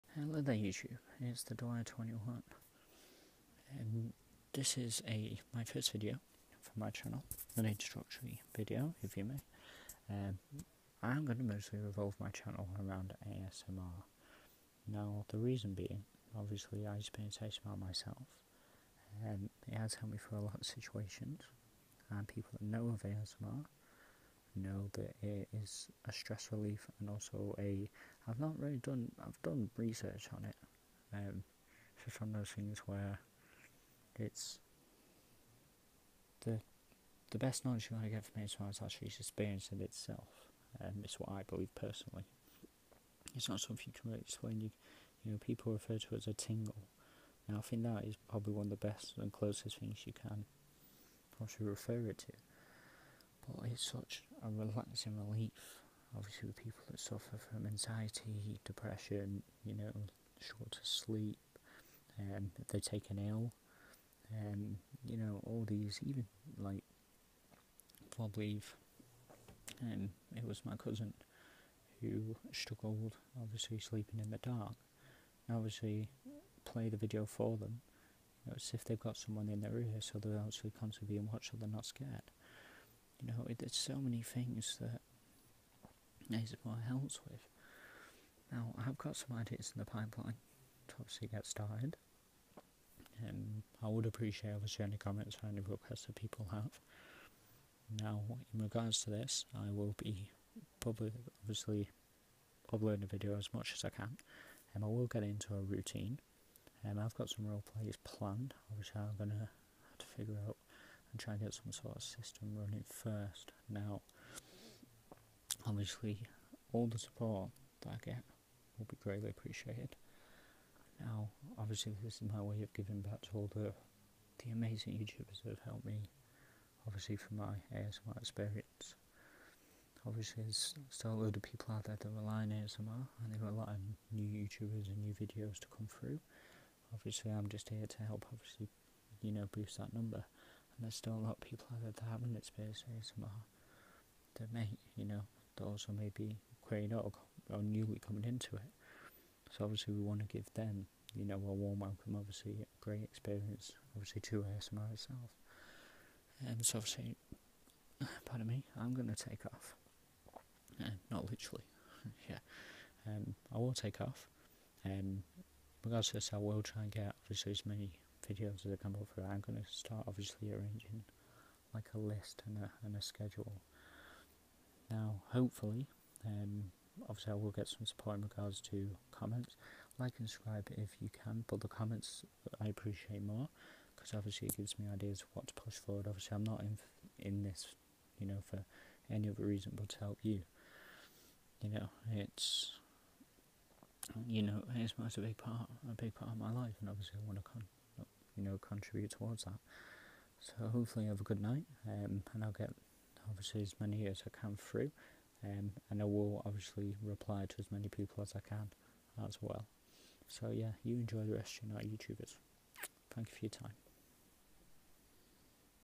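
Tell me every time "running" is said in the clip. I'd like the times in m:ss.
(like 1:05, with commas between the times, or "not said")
1:52.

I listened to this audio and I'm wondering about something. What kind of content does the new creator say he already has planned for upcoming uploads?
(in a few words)
role plays.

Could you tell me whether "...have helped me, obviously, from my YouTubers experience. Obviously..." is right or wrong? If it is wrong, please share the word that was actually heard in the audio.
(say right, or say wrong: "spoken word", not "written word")
wrong: "ASMR", not "YouTubers".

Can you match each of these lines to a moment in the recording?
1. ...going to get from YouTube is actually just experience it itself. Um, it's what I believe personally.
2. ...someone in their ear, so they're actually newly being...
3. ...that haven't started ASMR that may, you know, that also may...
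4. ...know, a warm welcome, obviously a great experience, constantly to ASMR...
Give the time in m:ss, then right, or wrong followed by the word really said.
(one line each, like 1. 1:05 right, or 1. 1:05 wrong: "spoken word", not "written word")
1. 0:37 wrong: "ASMR", not "YouTube"
2. 1:19 wrong: "constantly", not "newly"
3. 2:21 wrong: "experienced", not "started"
4. 2:31 wrong: "obviously", not "constantly".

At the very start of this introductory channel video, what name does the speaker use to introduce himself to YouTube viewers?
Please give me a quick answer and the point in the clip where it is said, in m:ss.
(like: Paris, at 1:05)
Dwyer21, at 0:01.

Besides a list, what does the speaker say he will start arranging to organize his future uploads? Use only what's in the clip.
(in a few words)
a schedule.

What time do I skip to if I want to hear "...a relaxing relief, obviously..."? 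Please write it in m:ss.
0:54.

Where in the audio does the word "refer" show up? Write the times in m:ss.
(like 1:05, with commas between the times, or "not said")
0:45, 0:51.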